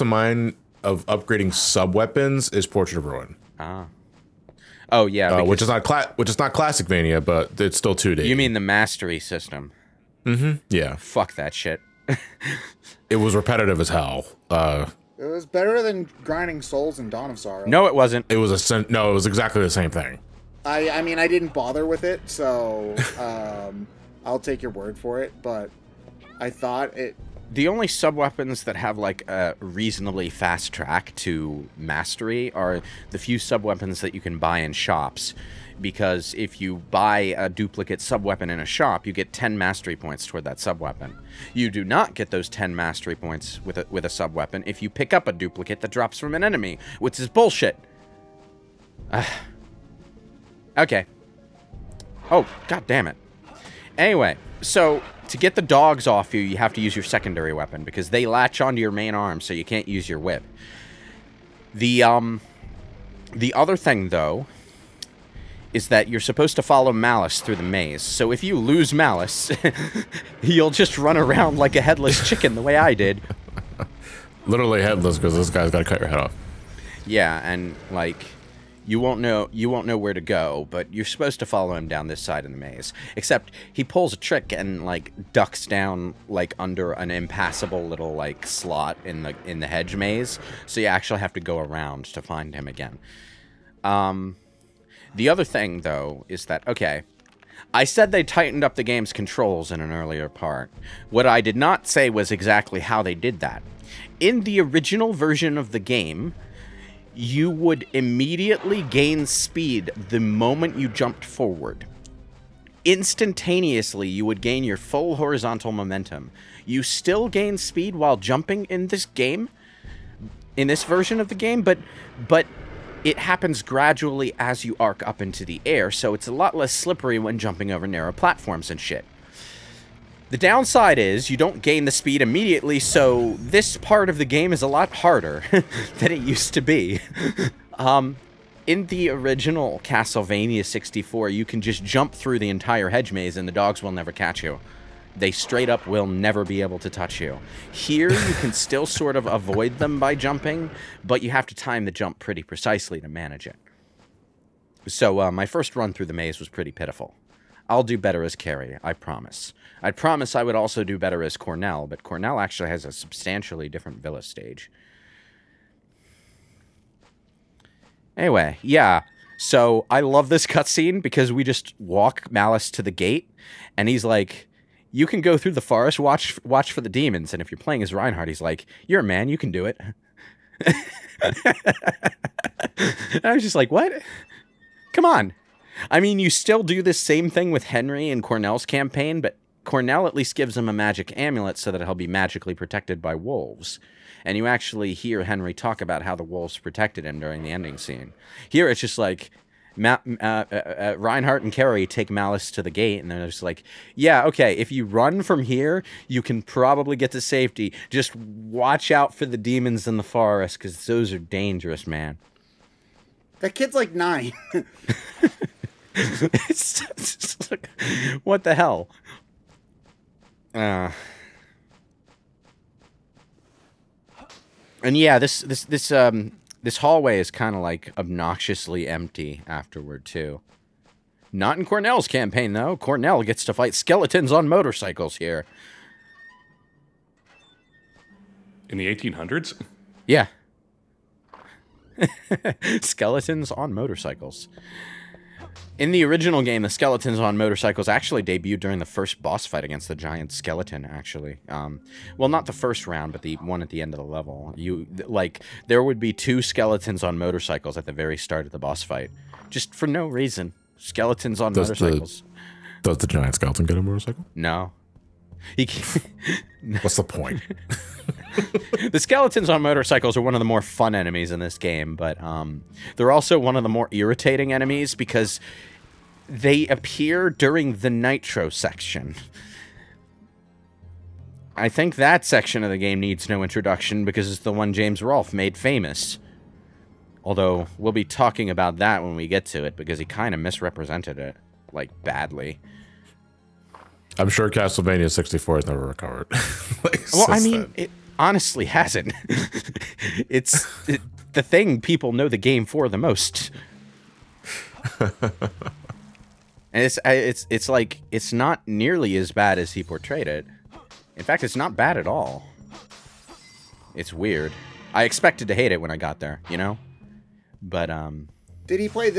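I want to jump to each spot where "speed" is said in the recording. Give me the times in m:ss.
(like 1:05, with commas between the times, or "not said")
1:49, 1:57, 2:11.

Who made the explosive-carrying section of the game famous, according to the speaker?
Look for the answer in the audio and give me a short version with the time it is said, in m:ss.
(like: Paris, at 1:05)
James Rolfe, at 4:44.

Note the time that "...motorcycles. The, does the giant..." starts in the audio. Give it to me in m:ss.
4:21.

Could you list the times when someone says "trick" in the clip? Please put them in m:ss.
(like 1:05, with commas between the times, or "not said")
1:24.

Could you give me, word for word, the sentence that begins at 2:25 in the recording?
They straight up will never be able to touch you.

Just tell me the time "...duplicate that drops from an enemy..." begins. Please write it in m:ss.
0:45.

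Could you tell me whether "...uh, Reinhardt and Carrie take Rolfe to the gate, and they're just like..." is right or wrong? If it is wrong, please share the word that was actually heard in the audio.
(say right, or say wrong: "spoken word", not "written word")
wrong: "Malice", not "Rolfe".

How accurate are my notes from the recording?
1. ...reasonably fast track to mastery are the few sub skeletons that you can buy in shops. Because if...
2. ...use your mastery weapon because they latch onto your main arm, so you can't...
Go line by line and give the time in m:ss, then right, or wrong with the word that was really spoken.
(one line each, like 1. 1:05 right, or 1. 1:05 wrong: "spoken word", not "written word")
1. 0:29 wrong: "weapons", not "skeletons"
2. 0:56 wrong: "secondary", not "mastery".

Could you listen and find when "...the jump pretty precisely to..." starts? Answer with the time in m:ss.
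2:31.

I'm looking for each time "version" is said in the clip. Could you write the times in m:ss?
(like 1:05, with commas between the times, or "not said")
1:45, 2:00.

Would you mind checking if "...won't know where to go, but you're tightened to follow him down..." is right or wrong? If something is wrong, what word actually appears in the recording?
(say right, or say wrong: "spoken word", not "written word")
wrong: "supposed", not "tightened".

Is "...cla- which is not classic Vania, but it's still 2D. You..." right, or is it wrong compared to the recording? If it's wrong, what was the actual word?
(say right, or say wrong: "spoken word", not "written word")
right.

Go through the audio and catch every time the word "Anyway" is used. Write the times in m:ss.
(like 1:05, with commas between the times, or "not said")
0:53, 2:48.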